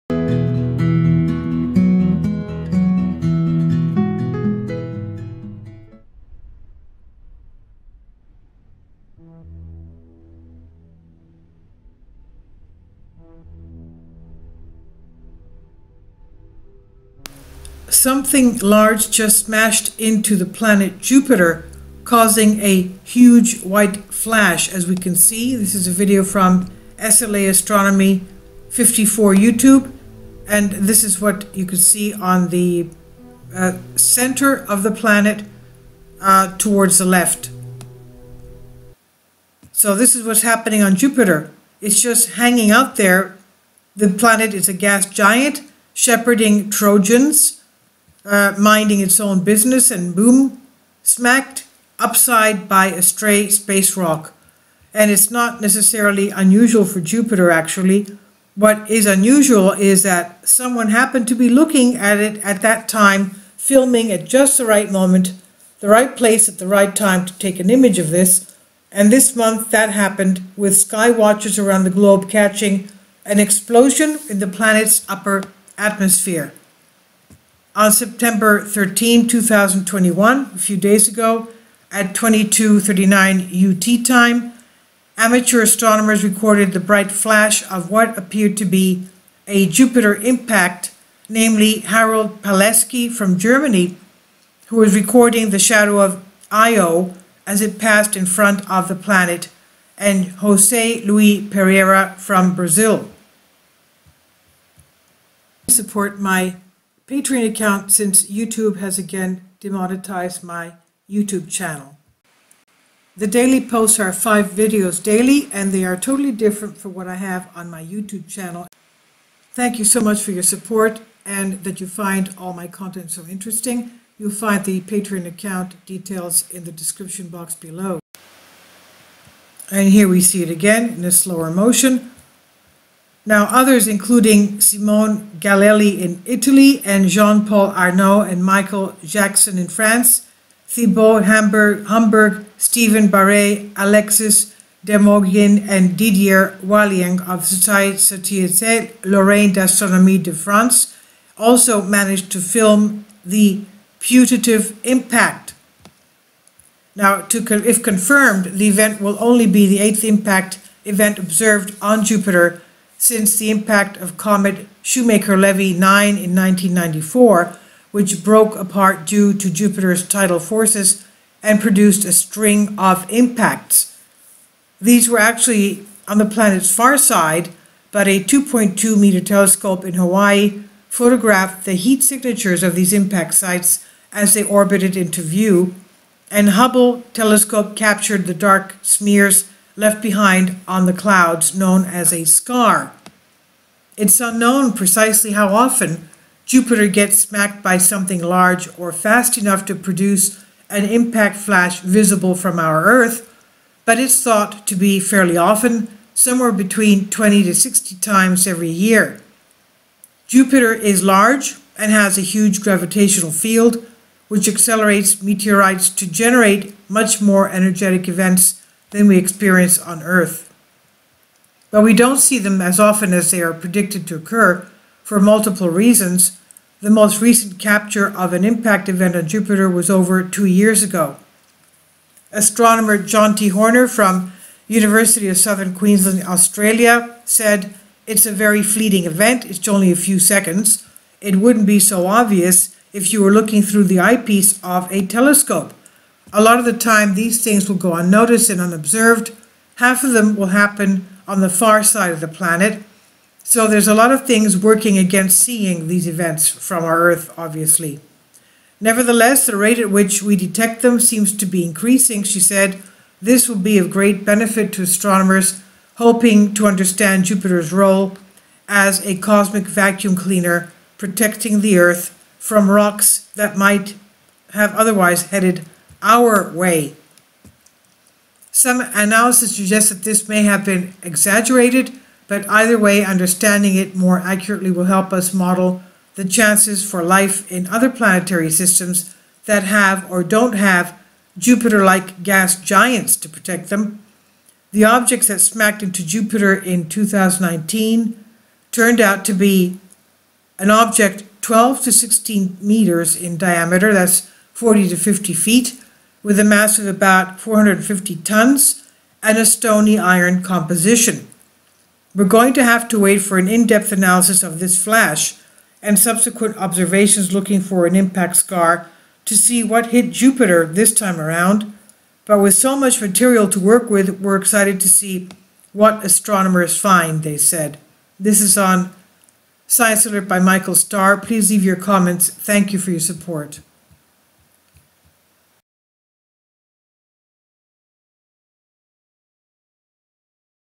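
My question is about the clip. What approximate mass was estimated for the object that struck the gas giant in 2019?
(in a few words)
450 tons.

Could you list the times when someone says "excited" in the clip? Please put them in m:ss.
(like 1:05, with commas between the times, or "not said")
5:24.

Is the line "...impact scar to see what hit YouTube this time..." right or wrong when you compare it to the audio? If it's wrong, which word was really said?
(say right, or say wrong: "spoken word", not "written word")
wrong: "Jupiter", not "YouTube".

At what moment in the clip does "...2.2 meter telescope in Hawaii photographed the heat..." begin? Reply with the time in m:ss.
2:58.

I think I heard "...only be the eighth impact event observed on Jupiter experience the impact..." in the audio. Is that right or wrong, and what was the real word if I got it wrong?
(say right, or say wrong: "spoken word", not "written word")
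wrong: "since", not "experience".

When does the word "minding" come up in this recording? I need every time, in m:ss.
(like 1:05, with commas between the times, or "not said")
0:48.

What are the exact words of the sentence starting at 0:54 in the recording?
And it's not necessarily unusual for Jupiter, actually.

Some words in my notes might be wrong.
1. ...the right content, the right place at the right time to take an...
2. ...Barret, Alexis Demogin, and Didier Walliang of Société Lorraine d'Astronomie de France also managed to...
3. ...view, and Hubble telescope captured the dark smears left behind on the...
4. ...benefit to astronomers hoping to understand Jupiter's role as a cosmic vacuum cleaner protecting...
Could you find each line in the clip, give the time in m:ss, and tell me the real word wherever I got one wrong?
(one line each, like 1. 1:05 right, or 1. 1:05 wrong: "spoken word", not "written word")
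1. 1:04 wrong: "moment", not "content"
2. 2:23 right
3. 3:05 right
4. 4:24 right.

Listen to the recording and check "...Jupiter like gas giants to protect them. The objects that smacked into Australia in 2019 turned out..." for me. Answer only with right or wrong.
wrong.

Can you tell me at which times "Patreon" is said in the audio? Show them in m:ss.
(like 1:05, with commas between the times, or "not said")
1:47, 2:04.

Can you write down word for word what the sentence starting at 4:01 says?
It wouldn't be so obvious if you were looking through the eyepiece of a telescope.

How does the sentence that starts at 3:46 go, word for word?
The most recent capture of an impact event on Jupiter was over two years ago.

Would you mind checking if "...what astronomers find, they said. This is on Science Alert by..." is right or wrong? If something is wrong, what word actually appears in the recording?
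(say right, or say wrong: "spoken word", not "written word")
right.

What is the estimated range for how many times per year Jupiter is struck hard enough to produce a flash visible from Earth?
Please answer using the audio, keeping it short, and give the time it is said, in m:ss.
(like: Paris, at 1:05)
20 to 60, at 3:27.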